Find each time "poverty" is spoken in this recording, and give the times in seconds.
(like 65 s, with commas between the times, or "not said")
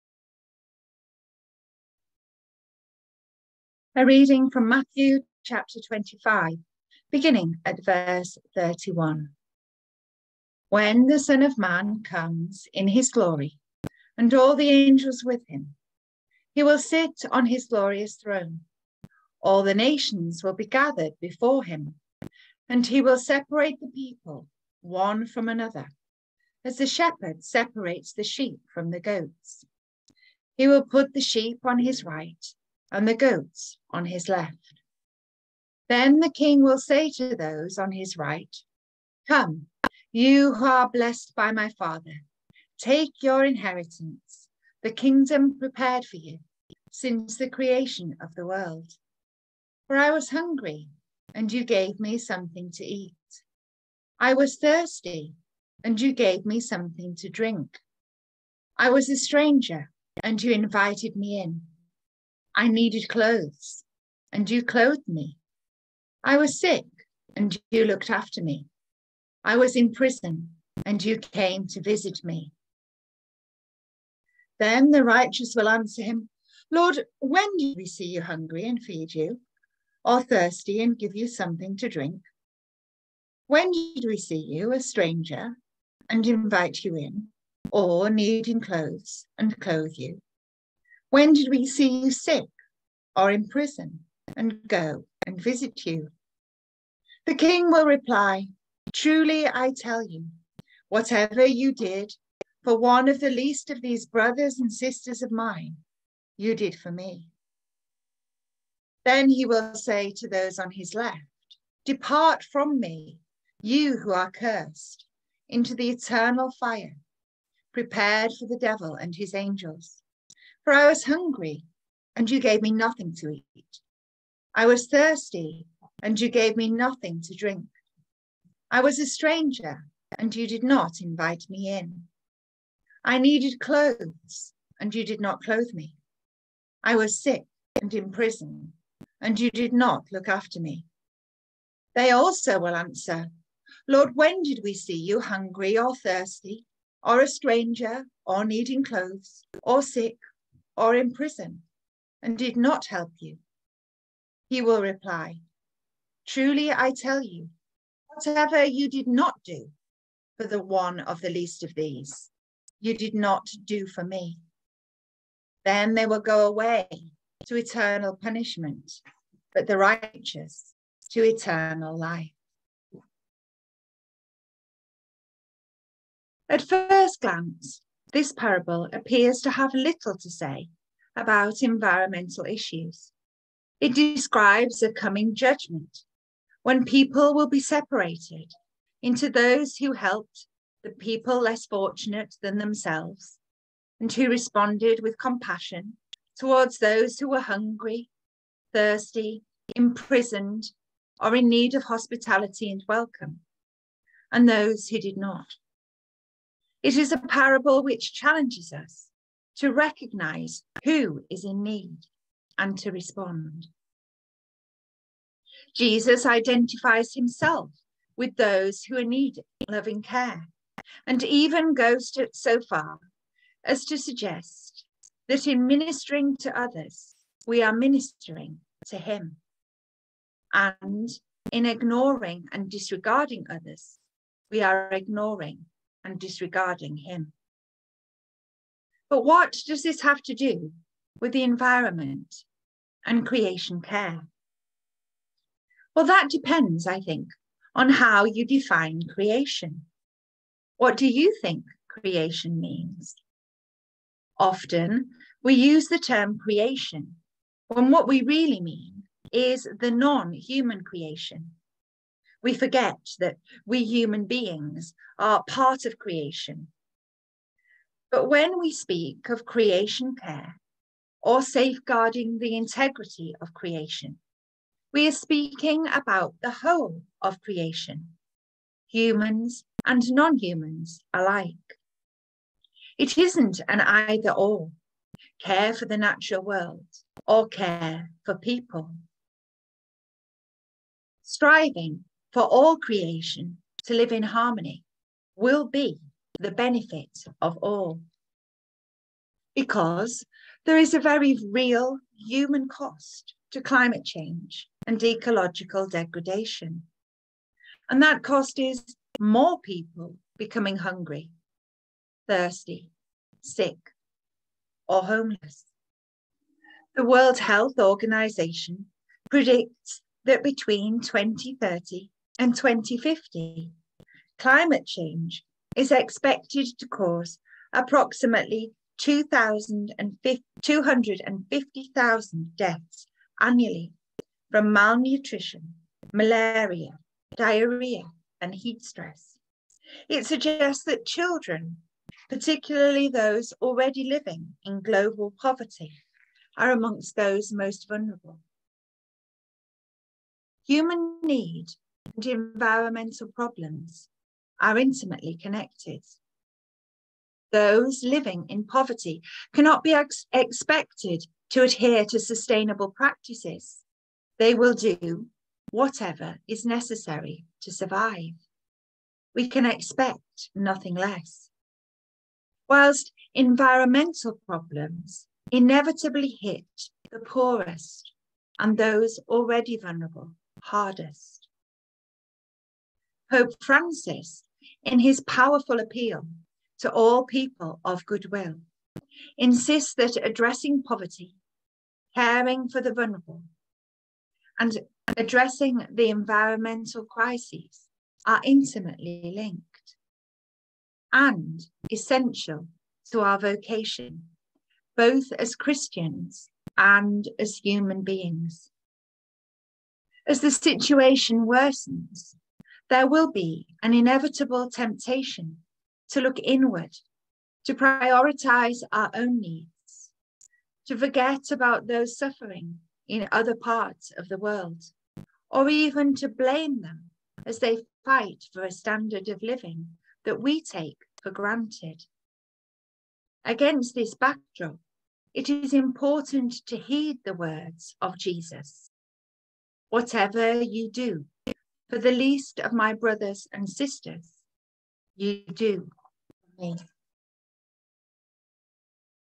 345 s, 358 s, 390 s.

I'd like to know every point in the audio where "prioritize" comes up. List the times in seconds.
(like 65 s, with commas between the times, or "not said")
417 s.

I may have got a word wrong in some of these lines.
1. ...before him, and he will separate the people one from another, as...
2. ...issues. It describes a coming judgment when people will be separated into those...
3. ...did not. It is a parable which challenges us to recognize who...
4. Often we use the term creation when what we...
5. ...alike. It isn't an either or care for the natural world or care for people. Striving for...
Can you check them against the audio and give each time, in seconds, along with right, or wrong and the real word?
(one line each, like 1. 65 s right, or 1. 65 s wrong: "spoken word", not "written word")
1. 21 s right
2. 182 s right
3. 204 s right
4. 254 s right
5. 281 s right.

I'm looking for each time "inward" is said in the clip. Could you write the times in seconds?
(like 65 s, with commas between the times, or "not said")
416 s.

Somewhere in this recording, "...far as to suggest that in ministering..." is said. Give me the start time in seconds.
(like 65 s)
222 s.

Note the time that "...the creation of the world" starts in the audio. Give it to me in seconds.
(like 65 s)
47 s.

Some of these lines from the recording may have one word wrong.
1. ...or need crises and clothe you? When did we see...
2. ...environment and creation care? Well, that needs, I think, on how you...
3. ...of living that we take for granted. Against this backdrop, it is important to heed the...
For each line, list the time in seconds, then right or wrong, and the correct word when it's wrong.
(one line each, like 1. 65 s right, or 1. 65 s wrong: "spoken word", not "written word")
1. 87 s wrong: "clothes", not "crises"
2. 241 s wrong: "depends", not "needs"
3. 429 s right.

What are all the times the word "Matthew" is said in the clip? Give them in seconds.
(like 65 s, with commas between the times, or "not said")
4 s.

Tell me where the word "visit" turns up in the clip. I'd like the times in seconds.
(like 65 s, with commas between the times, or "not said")
71 s, 95 s.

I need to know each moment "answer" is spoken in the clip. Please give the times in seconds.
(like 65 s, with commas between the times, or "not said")
75 s, 142 s.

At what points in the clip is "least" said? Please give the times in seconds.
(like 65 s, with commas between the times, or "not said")
103 s, 161 s, 442 s.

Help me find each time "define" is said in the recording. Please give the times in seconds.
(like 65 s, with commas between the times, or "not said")
248 s.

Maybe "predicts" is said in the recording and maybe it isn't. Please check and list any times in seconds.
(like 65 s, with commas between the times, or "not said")
319 s.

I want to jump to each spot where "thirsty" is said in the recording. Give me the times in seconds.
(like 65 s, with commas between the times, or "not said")
54 s, 80 s, 124 s, 145 s, 198 s, 312 s.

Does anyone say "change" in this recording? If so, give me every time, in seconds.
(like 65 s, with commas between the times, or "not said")
304 s, 324 s.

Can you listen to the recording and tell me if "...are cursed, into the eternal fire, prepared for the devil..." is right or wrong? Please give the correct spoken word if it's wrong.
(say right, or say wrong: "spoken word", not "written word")
right.